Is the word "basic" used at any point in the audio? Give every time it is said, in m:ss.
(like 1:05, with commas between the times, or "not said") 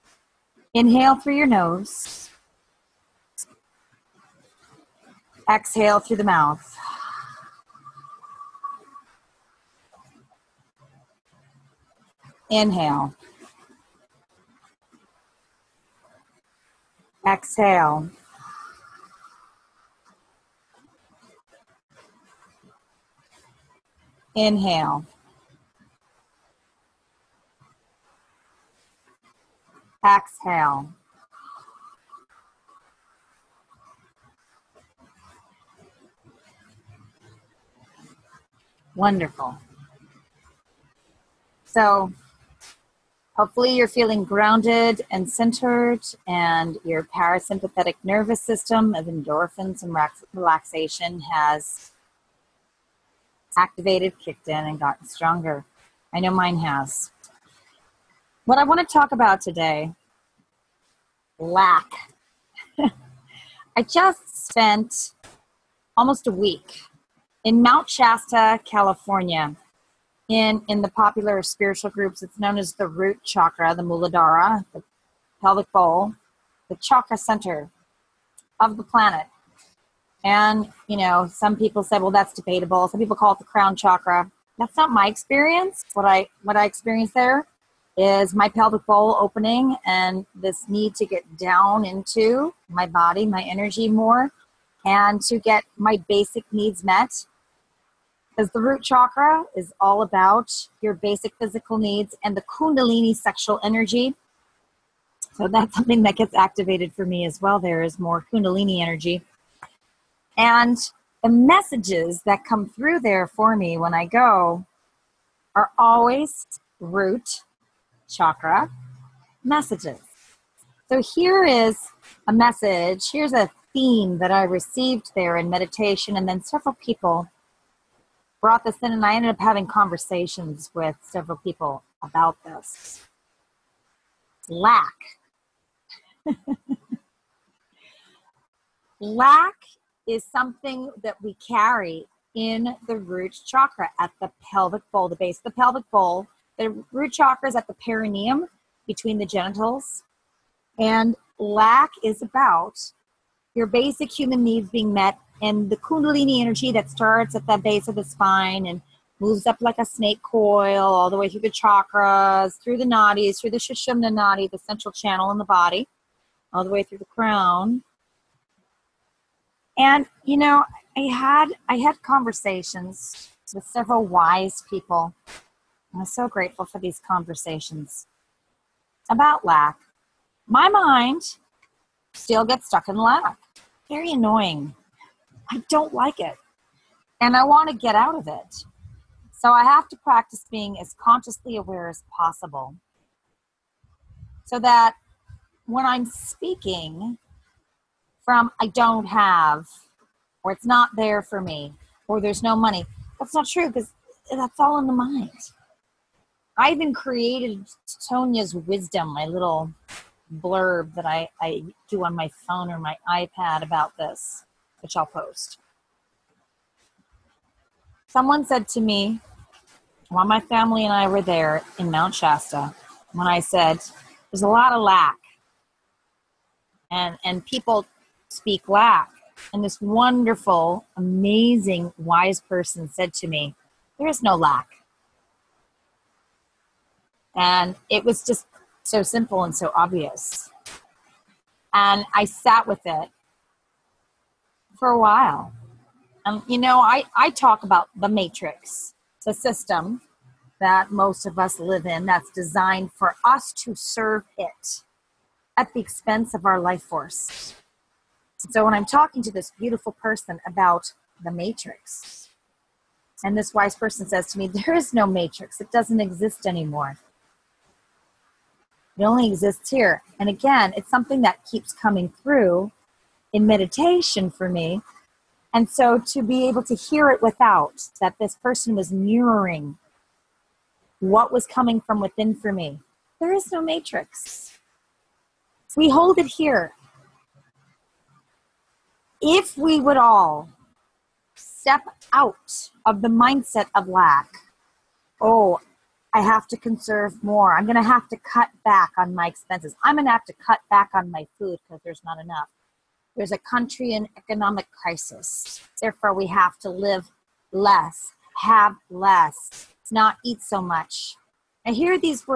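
1:36, 1:40, 2:33.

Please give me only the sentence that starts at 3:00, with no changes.
My mind still gets stuck in lack.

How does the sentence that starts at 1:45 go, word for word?
So that's something that gets activated for me as well.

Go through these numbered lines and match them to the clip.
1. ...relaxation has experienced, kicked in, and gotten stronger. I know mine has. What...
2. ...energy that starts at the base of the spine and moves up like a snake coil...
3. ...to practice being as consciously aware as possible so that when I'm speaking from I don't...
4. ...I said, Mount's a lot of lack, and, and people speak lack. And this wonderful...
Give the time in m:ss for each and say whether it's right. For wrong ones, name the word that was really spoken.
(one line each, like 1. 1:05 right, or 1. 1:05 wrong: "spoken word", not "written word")
1. 0:50 wrong: "activated", not "experienced"
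2. 2:36 right
3. 3:09 right
4. 3:43 wrong: "There", not "Mount".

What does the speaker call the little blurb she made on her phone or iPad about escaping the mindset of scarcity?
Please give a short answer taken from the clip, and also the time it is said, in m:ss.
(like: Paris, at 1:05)
Sonya's wisdom, at 3:27.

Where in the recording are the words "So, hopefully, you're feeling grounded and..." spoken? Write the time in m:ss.
0:41.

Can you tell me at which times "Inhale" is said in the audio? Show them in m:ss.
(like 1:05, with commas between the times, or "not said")
0:00, 0:12, 0:24.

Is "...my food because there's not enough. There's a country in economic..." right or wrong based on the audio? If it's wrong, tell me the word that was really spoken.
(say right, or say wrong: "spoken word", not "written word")
right.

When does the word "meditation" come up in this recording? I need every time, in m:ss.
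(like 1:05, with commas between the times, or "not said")
2:05, 4:33.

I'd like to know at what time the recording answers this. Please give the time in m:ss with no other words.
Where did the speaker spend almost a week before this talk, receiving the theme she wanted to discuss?
1:07.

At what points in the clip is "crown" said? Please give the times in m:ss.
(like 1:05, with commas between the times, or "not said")
1:23, 2:47.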